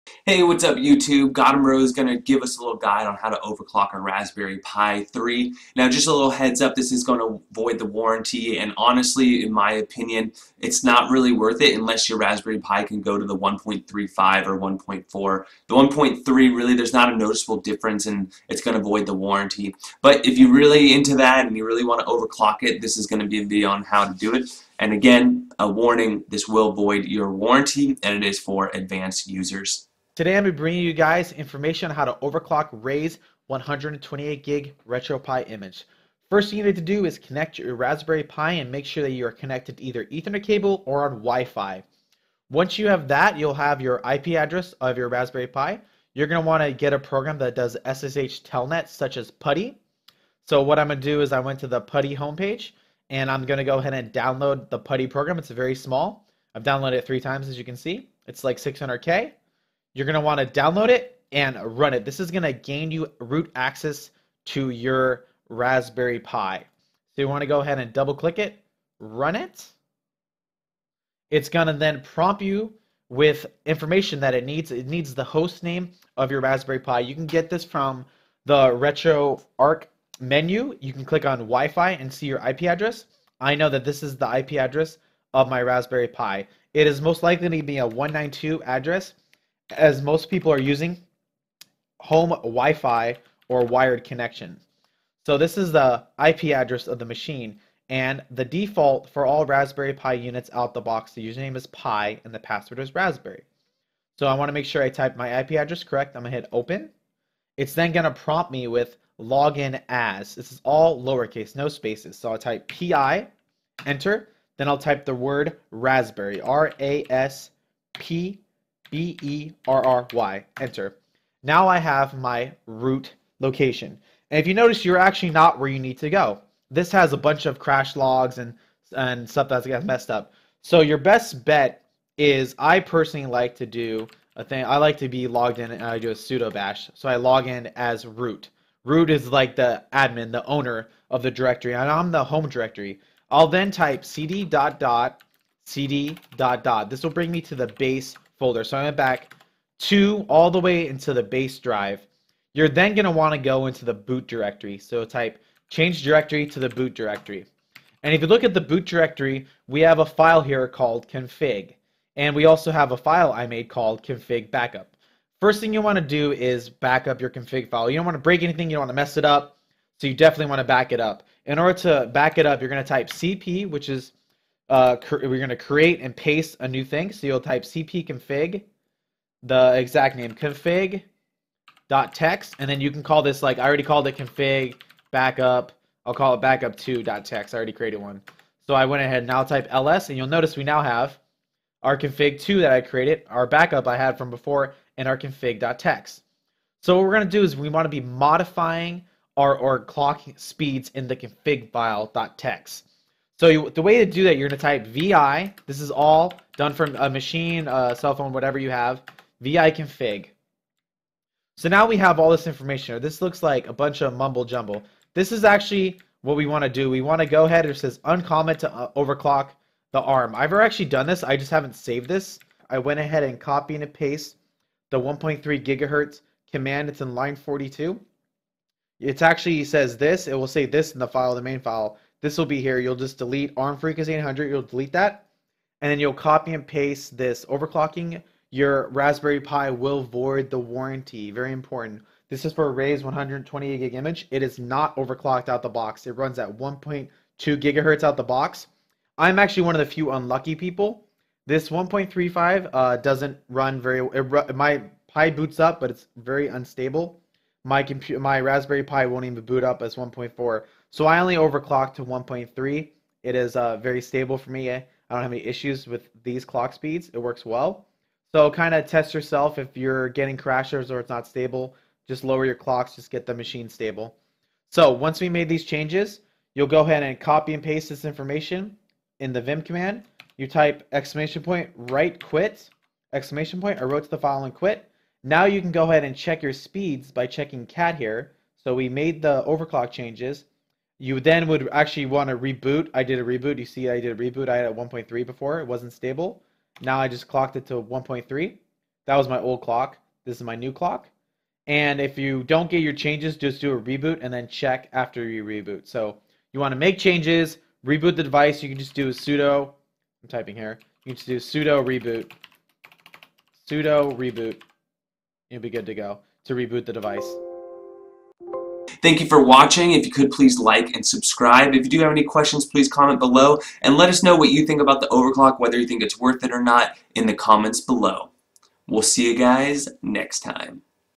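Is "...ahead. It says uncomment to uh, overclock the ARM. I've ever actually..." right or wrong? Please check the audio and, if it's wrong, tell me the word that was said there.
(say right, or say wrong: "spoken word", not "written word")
right.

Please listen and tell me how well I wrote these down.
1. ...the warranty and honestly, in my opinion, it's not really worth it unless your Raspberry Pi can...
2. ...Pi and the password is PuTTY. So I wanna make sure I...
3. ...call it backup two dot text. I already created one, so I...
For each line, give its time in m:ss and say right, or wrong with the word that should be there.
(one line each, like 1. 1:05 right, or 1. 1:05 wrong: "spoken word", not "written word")
1. 0:07 right
2. 1:41 wrong: "Raspberry", not "PuTTY"
3. 3:06 right.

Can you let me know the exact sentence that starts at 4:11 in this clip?
This 1.35 uh, doesn't run very.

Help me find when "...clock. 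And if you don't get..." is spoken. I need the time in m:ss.
5:00.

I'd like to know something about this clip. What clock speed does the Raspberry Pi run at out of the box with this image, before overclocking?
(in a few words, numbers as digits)
1.2 gigahertz.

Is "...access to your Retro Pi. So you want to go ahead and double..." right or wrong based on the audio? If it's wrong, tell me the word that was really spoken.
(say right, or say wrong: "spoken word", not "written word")
wrong: "Raspberry", not "Retro".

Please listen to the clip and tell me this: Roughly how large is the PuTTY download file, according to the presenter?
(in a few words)
600K.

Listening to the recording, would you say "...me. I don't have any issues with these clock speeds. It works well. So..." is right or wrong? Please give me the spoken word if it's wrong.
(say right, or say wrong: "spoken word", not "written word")
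right.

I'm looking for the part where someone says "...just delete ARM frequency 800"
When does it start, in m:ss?
3:52.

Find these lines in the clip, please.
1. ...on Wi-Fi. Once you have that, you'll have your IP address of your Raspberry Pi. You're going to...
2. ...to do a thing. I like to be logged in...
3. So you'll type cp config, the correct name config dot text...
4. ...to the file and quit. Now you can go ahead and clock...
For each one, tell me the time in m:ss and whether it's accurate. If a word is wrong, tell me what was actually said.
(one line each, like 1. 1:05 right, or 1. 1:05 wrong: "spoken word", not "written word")
1. 0:41 right
2. 2:13 right
3. 2:57 wrong: "exact", not "correct"
4. 4:44 wrong: "check", not "clock".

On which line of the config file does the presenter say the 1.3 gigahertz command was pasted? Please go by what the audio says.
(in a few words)
42.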